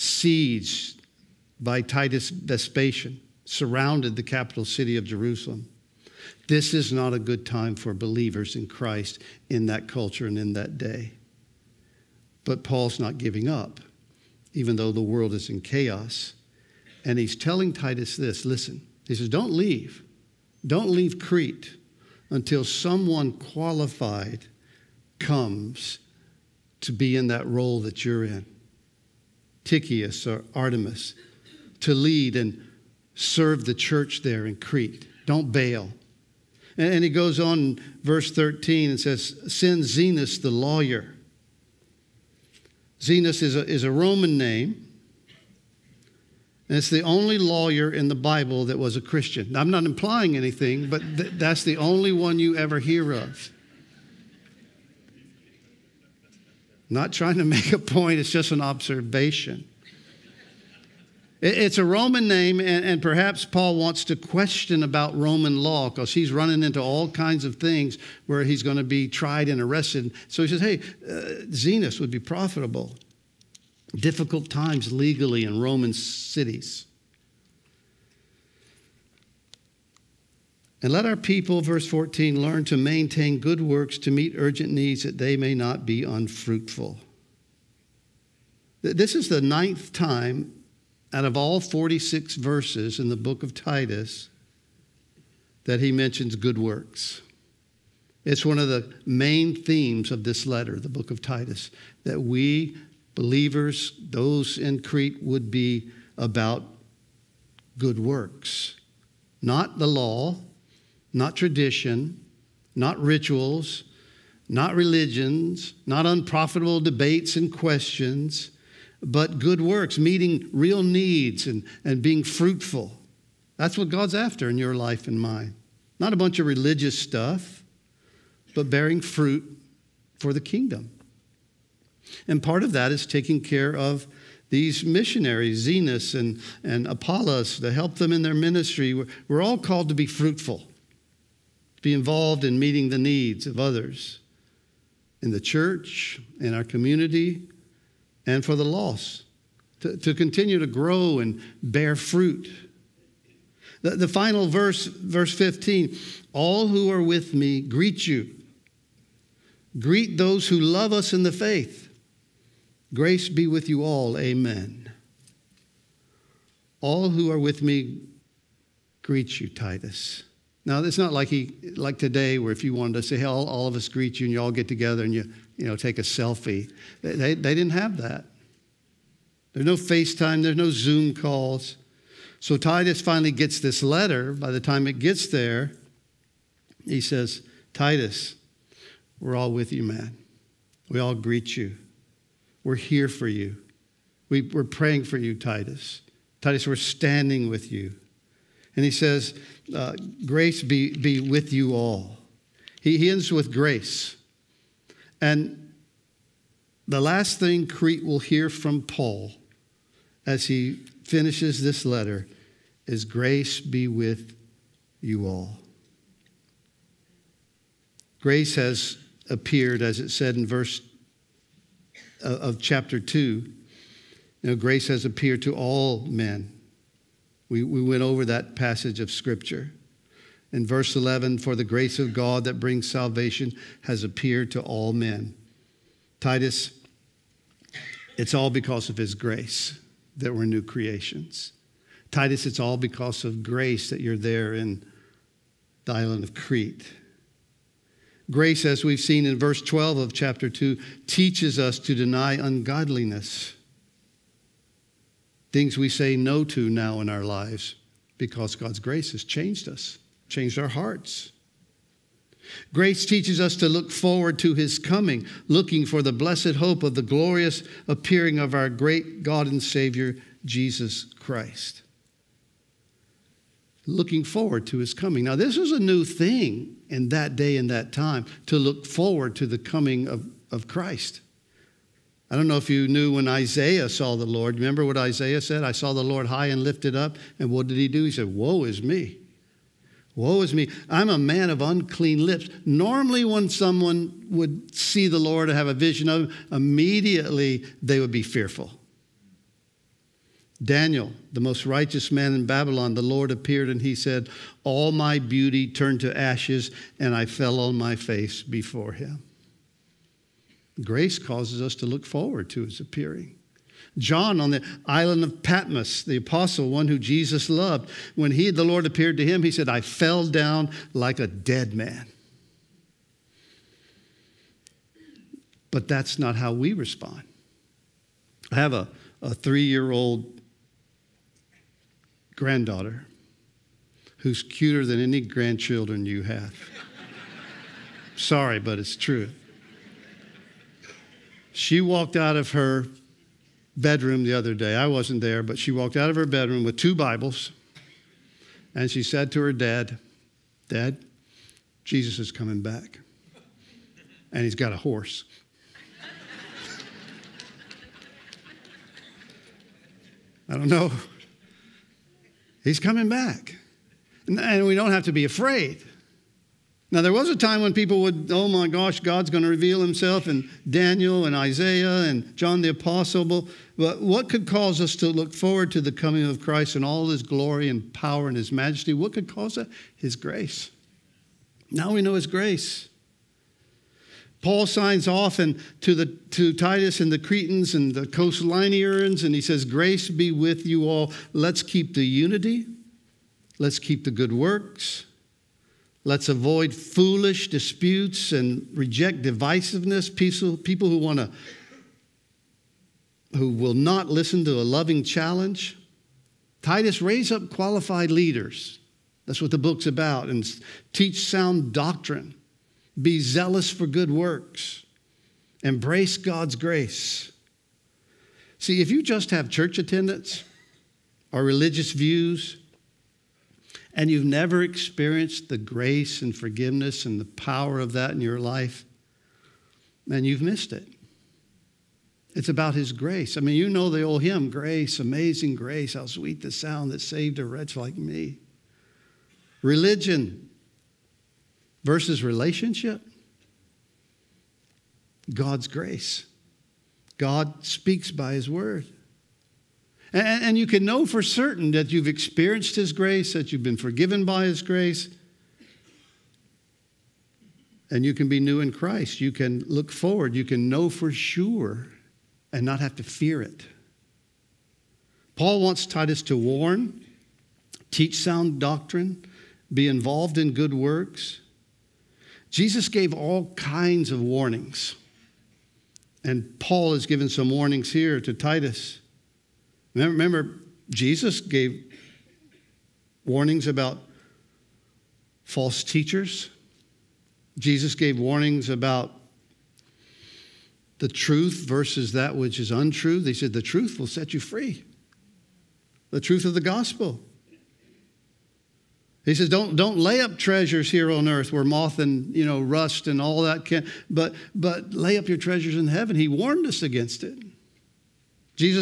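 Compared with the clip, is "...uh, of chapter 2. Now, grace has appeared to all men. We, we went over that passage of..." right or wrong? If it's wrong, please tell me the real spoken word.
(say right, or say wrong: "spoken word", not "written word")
right.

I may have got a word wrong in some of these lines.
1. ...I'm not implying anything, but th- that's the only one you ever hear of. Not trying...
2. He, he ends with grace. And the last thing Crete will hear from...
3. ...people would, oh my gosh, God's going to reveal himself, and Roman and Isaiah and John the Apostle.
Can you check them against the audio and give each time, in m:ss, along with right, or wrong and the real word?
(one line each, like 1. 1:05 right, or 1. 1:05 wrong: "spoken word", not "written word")
1. 0:49 right
2. 3:22 right
3. 6:07 wrong: "Daniel", not "Roman".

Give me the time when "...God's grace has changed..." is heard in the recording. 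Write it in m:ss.
4:18.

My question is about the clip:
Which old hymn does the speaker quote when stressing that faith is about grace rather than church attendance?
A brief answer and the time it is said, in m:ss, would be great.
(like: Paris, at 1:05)
Amazing Grace, at 7:14.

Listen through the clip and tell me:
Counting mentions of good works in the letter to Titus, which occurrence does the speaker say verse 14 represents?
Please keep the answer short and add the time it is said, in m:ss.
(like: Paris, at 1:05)
ninth, at 1:29.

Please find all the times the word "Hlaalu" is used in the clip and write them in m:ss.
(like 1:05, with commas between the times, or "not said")
not said.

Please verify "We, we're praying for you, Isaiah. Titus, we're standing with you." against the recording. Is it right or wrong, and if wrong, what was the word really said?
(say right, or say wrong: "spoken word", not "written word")
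wrong: "Titus", not "Isaiah".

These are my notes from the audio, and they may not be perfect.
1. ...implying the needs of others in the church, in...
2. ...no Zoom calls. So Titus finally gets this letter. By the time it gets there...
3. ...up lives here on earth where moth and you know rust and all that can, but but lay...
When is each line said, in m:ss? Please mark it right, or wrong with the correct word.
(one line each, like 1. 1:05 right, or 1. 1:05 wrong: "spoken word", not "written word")
1. 2:22 wrong: "meeting", not "implying"
2. 3:00 right
3. 8:20 wrong: "treasures", not "lives".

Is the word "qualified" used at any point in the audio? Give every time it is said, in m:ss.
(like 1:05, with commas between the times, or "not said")
0:23, 6:47.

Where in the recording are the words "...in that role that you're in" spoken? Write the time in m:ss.
0:27.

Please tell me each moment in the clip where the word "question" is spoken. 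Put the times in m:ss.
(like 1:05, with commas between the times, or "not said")
1:04, 1:57.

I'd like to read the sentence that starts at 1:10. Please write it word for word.
So he says, Hey, uh, Zenas would be profitable.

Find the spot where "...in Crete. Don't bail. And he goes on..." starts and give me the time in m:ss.
0:34.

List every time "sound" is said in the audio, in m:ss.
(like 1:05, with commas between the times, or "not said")
6:51, 7:16, 7:48.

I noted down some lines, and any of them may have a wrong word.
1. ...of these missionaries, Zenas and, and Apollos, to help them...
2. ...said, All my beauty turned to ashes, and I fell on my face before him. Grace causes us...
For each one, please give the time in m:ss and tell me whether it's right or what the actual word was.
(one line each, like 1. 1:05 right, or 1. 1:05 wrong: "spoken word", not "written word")
1. 2:13 right
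2. 5:03 right.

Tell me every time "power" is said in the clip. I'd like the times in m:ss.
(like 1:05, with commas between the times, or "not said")
6:17, 7:07.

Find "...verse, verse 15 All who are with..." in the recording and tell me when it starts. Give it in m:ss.
2:34.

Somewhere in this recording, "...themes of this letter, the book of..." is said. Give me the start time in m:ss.
1:39.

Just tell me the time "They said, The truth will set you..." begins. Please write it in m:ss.
8:13.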